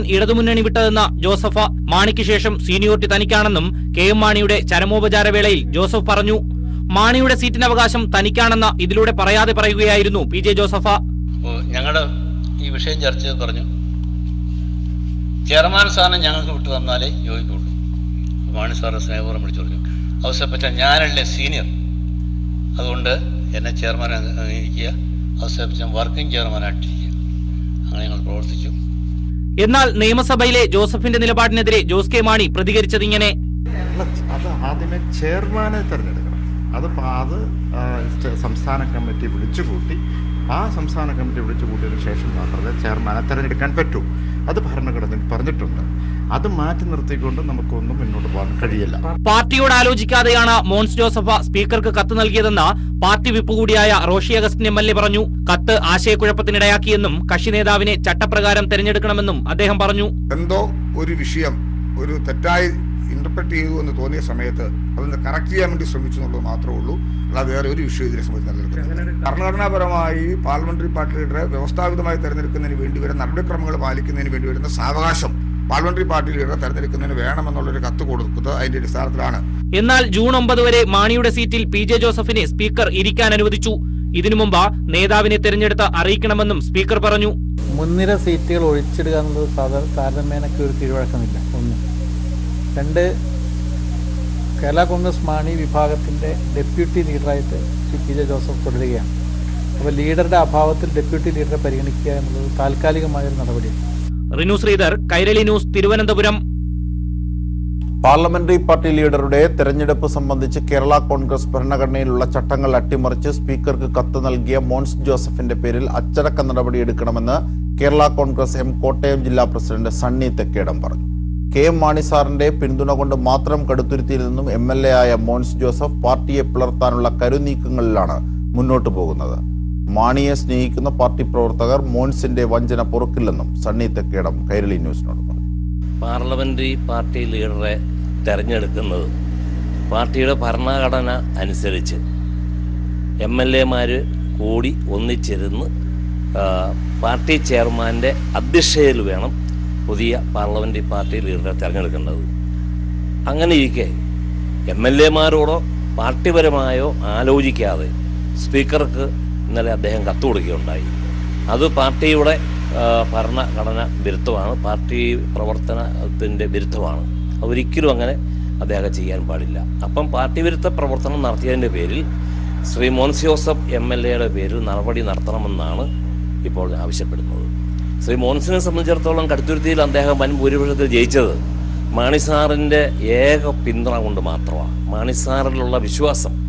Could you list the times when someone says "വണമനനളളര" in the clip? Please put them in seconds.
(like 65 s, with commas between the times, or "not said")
77 s.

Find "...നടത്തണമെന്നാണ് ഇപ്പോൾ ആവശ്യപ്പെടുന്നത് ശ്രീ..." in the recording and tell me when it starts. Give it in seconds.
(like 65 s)
175 s.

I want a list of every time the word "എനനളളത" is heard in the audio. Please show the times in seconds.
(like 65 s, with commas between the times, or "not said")
66 s, 89 s, 102 s.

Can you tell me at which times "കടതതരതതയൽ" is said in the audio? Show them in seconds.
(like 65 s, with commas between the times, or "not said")
123 s, 179 s.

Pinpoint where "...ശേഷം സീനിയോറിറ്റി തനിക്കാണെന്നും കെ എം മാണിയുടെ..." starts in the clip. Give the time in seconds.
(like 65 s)
2 s.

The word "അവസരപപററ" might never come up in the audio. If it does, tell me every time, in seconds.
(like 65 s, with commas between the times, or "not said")
20 s, 25 s.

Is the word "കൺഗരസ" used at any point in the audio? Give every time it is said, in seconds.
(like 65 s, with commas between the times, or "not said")
94 s, 111 s, 118 s.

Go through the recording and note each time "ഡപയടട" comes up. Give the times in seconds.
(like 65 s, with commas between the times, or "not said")
96 s, 100 s.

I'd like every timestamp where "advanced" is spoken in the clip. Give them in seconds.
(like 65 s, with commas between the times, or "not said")
not said.